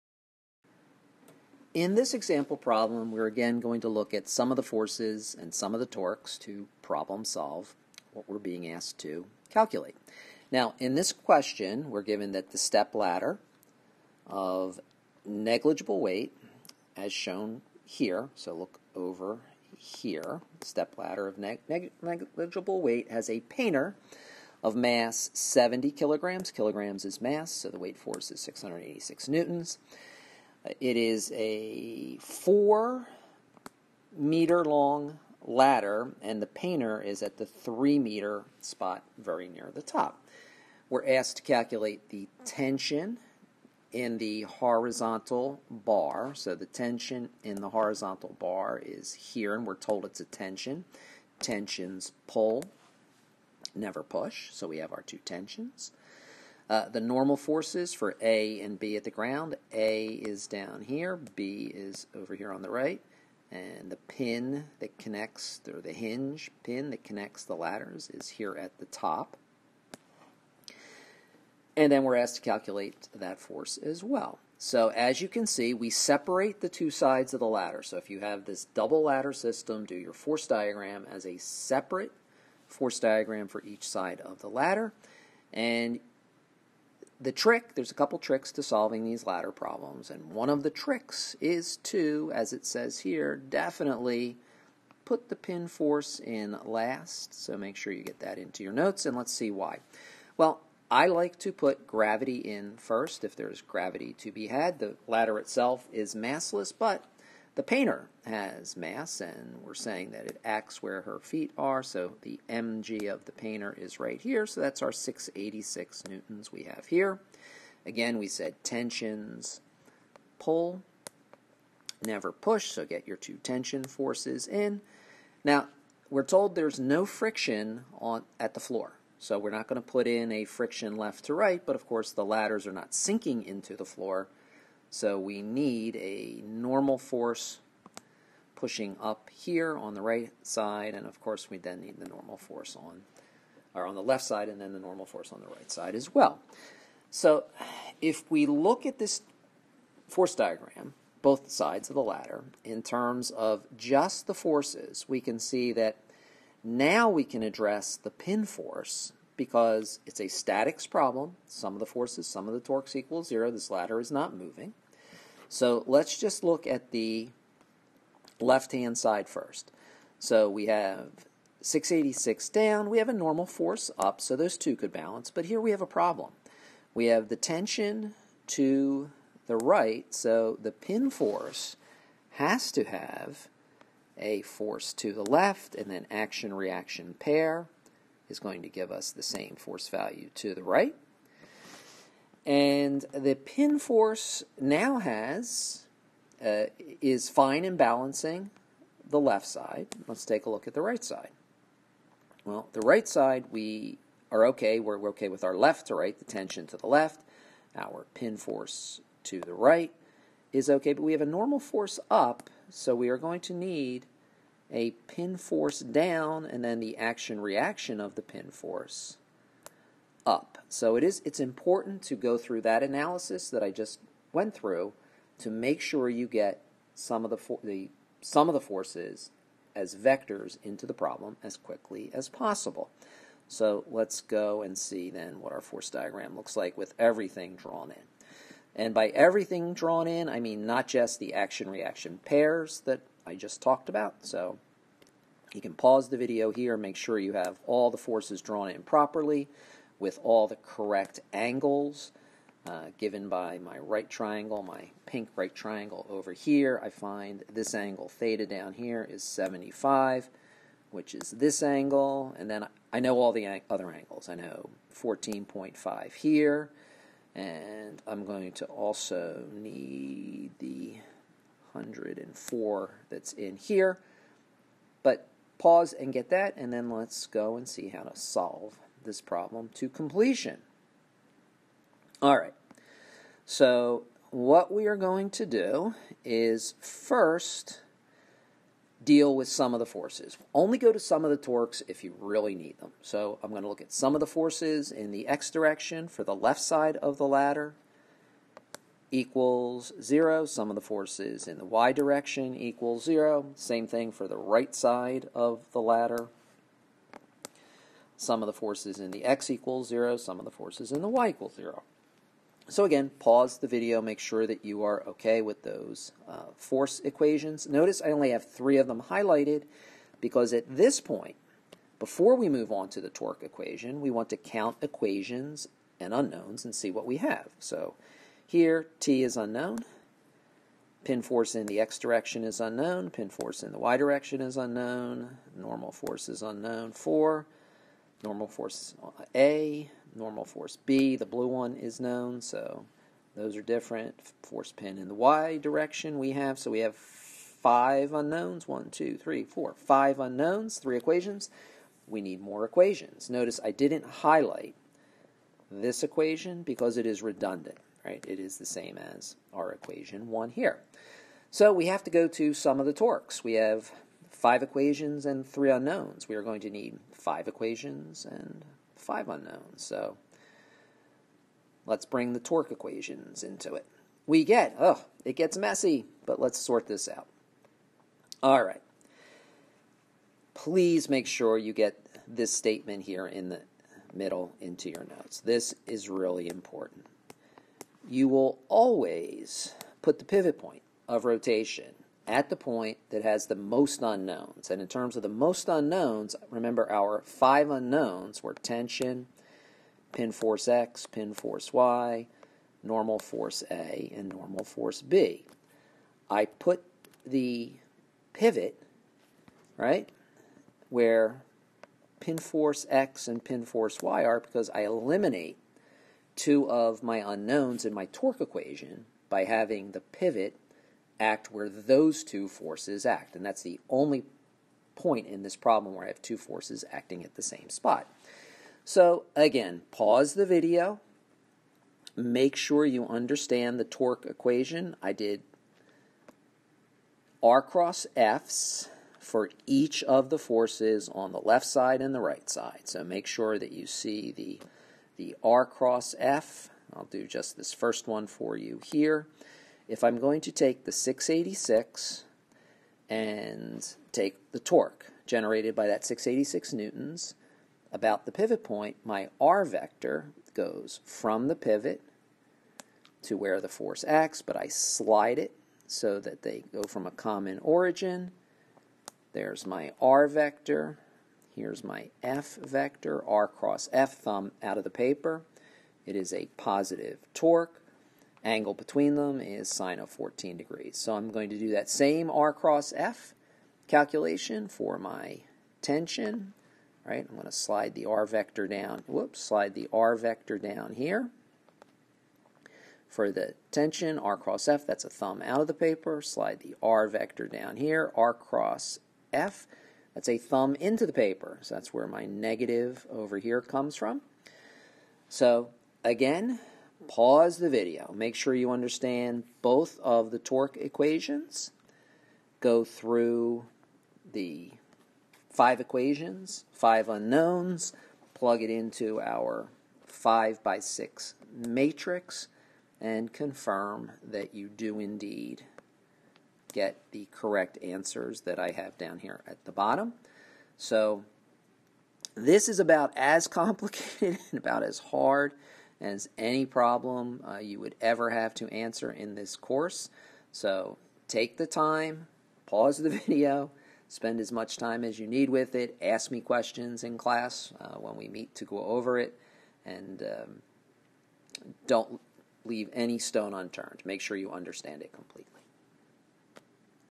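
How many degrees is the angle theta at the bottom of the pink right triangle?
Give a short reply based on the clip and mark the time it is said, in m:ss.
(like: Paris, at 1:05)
75, at 4:19.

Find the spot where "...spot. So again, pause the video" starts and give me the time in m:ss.
7:07.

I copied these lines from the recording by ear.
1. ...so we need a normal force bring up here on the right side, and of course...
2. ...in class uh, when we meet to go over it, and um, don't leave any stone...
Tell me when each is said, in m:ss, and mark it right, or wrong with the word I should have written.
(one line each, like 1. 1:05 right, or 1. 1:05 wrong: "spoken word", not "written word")
1. 2:14 wrong: "pushing", not "bring"
2. 9:07 right.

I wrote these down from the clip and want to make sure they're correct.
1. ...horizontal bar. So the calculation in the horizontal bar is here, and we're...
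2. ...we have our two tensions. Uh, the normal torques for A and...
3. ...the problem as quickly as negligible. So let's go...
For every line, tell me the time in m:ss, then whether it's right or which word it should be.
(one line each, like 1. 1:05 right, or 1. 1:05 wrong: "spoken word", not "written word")
1. 0:44 wrong: "tension", not "calculation"
2. 0:54 wrong: "forces", not "torques"
3. 3:50 wrong: "possible", not "negligible".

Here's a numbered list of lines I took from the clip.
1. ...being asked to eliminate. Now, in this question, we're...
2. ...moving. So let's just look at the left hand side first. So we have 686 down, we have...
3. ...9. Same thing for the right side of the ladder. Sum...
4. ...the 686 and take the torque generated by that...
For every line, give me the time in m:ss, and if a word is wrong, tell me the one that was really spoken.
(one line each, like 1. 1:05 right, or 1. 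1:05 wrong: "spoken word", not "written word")
1. 0:08 wrong: "calculate", not "eliminate"
2. 2:44 right
3. 5:03 wrong: "0", not "9"
4. 7:30 right.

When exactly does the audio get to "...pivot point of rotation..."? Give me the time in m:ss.
6:30.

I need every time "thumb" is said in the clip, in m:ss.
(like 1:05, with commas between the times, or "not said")
7:54, 8:15, 8:20.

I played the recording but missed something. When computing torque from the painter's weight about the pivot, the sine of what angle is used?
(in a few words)
14 degrees.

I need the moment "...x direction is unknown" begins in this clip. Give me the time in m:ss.
5:31.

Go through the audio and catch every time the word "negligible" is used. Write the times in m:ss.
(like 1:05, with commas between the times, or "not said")
0:15, 0:22.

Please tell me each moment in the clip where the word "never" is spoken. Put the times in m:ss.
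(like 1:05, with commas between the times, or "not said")
0:53, 2:02.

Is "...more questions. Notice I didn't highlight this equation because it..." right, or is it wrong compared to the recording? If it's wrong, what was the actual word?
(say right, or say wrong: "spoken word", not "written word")
wrong: "equations", not "questions".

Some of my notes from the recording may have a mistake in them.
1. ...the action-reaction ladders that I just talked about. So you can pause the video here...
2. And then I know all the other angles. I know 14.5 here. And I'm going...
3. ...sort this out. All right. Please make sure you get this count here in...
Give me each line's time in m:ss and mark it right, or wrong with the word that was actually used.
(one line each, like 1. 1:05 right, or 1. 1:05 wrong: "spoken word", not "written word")
1. 4:01 wrong: "pairs", not "ladders"
2. 4:22 right
3. 6:16 wrong: "statement", not "count".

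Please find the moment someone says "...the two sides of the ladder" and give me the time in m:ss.
1:16.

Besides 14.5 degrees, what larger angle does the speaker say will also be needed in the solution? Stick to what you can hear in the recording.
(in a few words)
104.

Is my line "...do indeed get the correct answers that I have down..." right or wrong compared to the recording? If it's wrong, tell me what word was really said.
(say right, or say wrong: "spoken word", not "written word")
right.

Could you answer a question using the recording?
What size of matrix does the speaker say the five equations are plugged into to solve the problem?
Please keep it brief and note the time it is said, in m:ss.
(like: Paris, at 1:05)
5 by 6, at 8:40.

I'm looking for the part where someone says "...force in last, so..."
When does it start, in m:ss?
1:35.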